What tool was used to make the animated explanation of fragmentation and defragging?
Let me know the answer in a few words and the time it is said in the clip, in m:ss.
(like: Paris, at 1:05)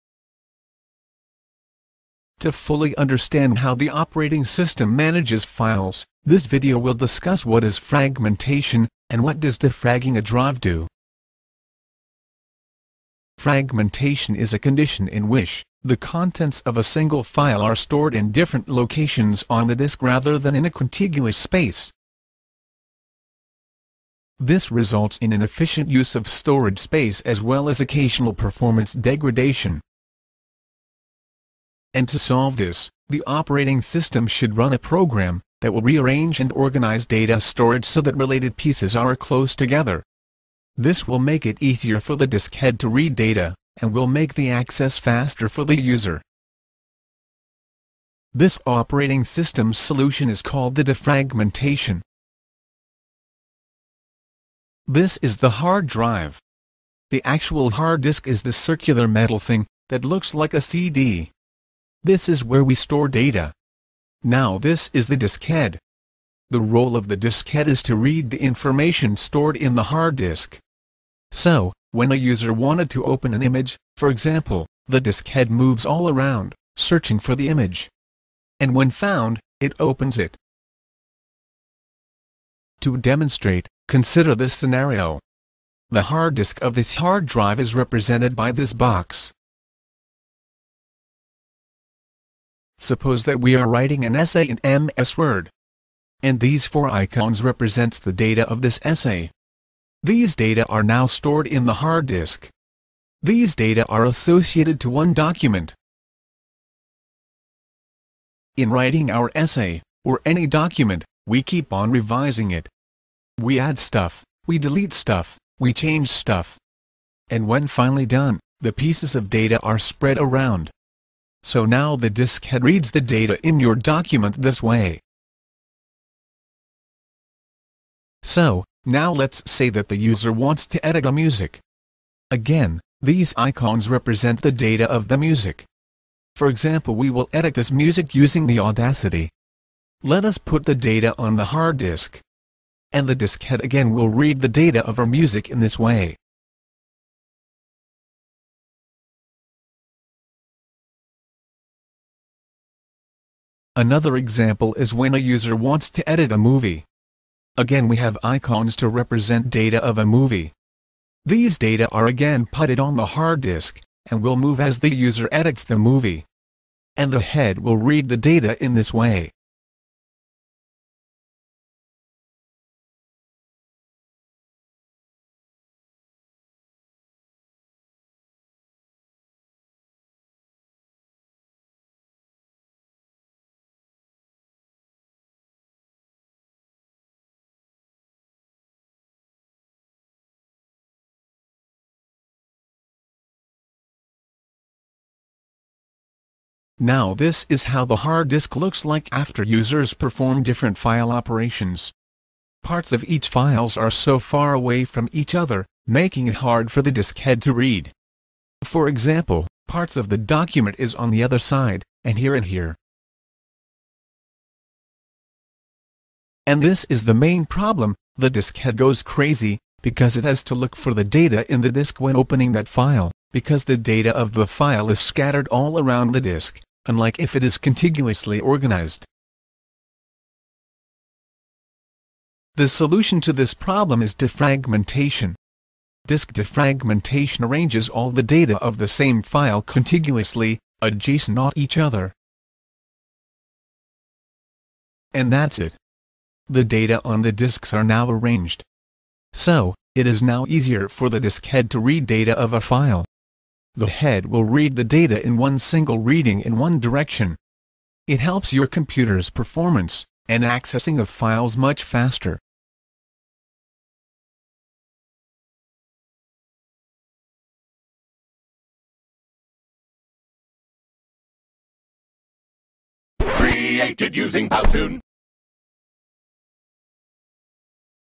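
Powtoon, at 4:34.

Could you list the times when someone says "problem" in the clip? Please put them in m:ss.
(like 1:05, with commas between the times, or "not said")
3:37, 3:53.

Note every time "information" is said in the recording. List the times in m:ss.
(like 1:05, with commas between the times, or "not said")
1:08.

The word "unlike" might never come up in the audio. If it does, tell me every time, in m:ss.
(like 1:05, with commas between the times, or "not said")
3:46.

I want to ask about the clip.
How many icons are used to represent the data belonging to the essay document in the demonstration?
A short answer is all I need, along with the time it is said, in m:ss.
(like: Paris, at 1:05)
4, at 1:36.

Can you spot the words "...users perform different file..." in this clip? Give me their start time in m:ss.
3:19.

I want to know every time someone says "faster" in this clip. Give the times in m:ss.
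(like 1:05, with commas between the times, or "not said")
0:44, 4:21.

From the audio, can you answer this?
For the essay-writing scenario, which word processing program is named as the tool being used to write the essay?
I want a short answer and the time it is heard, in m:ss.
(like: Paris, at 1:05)
MS Word, at 1:34.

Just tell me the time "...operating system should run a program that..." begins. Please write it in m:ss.
0:33.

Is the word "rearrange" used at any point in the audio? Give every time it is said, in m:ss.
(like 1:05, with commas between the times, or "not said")
0:35.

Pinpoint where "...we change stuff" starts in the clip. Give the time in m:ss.
1:55.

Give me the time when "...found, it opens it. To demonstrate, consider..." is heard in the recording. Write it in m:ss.
1:18.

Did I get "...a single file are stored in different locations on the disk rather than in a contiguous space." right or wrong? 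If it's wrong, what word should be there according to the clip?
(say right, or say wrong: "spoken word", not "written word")
right.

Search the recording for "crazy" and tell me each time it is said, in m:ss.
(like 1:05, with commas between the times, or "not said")
3:39.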